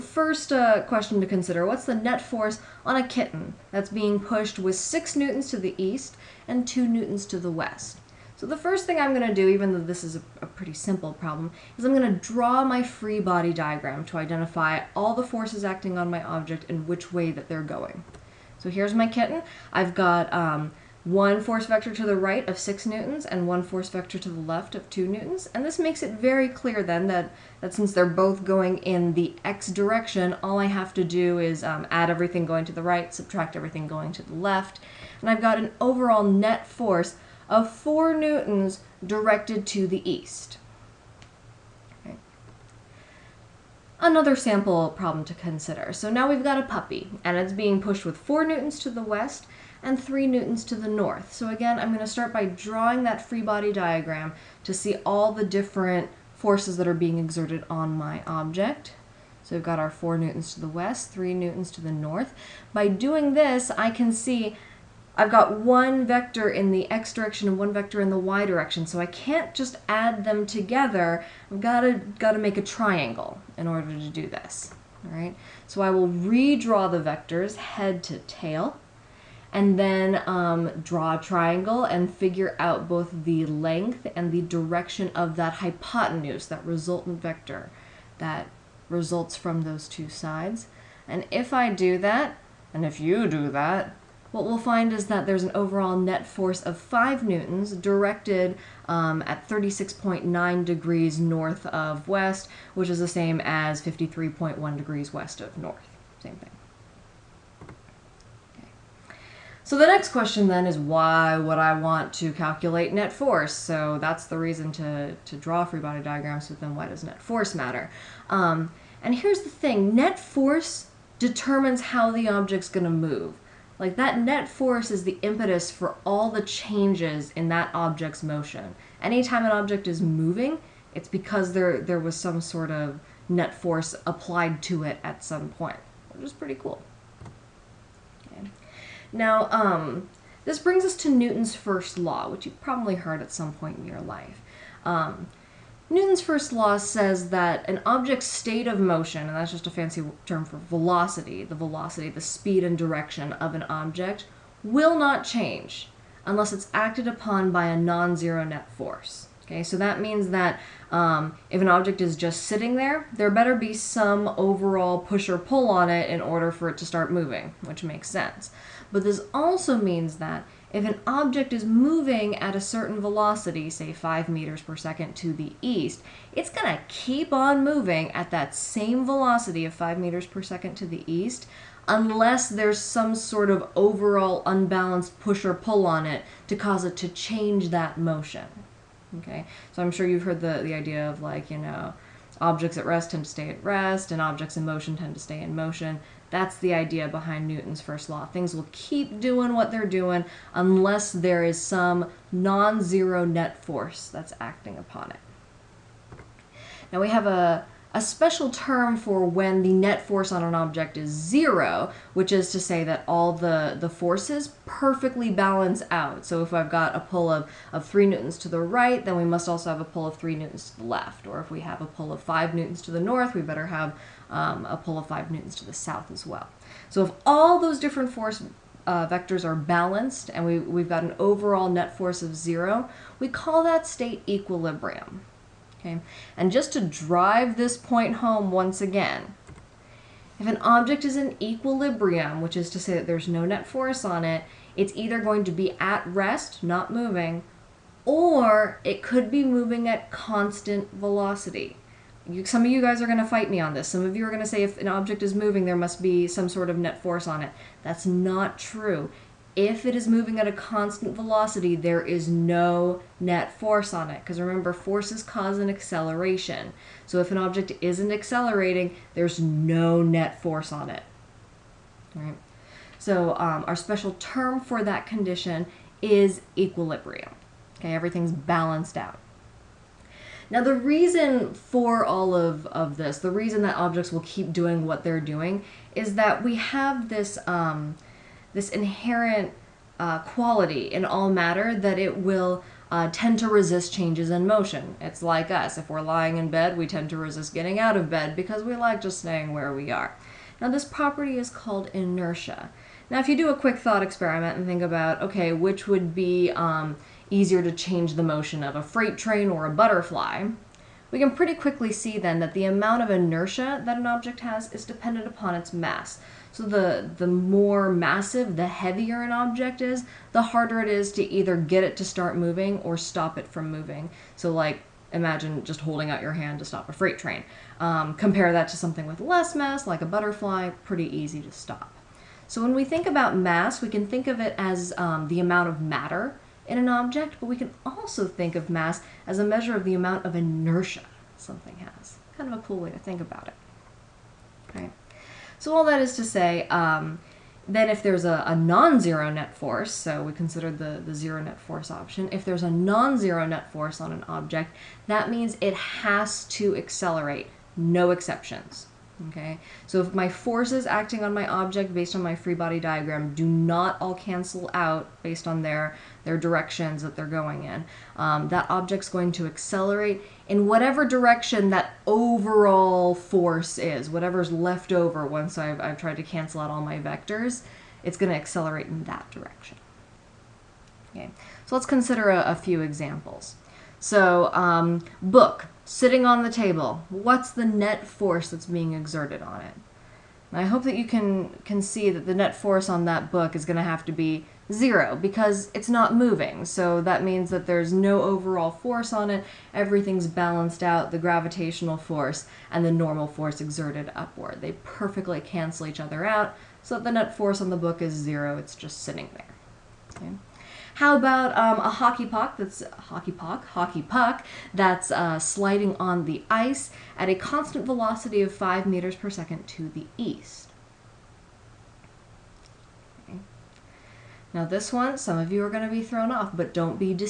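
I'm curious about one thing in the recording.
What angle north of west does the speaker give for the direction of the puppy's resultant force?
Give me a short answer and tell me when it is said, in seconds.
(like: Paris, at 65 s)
36.9 degrees, at 99 s.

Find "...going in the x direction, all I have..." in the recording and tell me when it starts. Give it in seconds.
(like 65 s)
28 s.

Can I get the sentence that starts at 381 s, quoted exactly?
Okay, so let's consider a, a few examples.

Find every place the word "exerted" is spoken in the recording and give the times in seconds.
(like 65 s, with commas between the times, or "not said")
57 s, 388 s, 403 s.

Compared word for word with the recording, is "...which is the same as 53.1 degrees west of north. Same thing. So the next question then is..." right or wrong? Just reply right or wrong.
right.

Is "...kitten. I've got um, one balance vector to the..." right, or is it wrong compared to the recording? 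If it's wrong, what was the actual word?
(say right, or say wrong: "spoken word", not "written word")
wrong: "force", not "balance".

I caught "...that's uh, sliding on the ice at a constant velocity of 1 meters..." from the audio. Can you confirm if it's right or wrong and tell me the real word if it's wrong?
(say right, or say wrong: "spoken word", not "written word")
wrong: "5", not "1".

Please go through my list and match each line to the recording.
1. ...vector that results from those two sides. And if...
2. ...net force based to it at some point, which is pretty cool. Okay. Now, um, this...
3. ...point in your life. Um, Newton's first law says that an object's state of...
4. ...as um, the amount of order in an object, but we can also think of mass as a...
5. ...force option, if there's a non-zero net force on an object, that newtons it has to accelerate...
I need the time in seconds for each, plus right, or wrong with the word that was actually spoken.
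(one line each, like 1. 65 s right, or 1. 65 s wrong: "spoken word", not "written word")
1. 87 s right
2. 133 s wrong: "applied", not "based"
3. 143 s right
4. 334 s wrong: "matter", not "order"
5. 351 s wrong: "means", not "newtons".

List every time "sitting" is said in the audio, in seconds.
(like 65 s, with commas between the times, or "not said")
162 s, 385 s, 409 s.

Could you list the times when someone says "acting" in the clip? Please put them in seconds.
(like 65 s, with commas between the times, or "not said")
15 s, 204 s, 360 s.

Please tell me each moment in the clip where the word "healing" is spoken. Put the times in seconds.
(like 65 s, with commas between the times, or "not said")
not said.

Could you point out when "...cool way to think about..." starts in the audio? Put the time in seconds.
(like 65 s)
342 s.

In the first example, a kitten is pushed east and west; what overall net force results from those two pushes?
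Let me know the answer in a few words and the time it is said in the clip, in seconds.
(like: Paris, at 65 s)
4 newtons east, at 37 s.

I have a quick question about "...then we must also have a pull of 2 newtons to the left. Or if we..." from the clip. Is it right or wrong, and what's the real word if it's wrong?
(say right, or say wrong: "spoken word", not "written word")
wrong: "3", not "2".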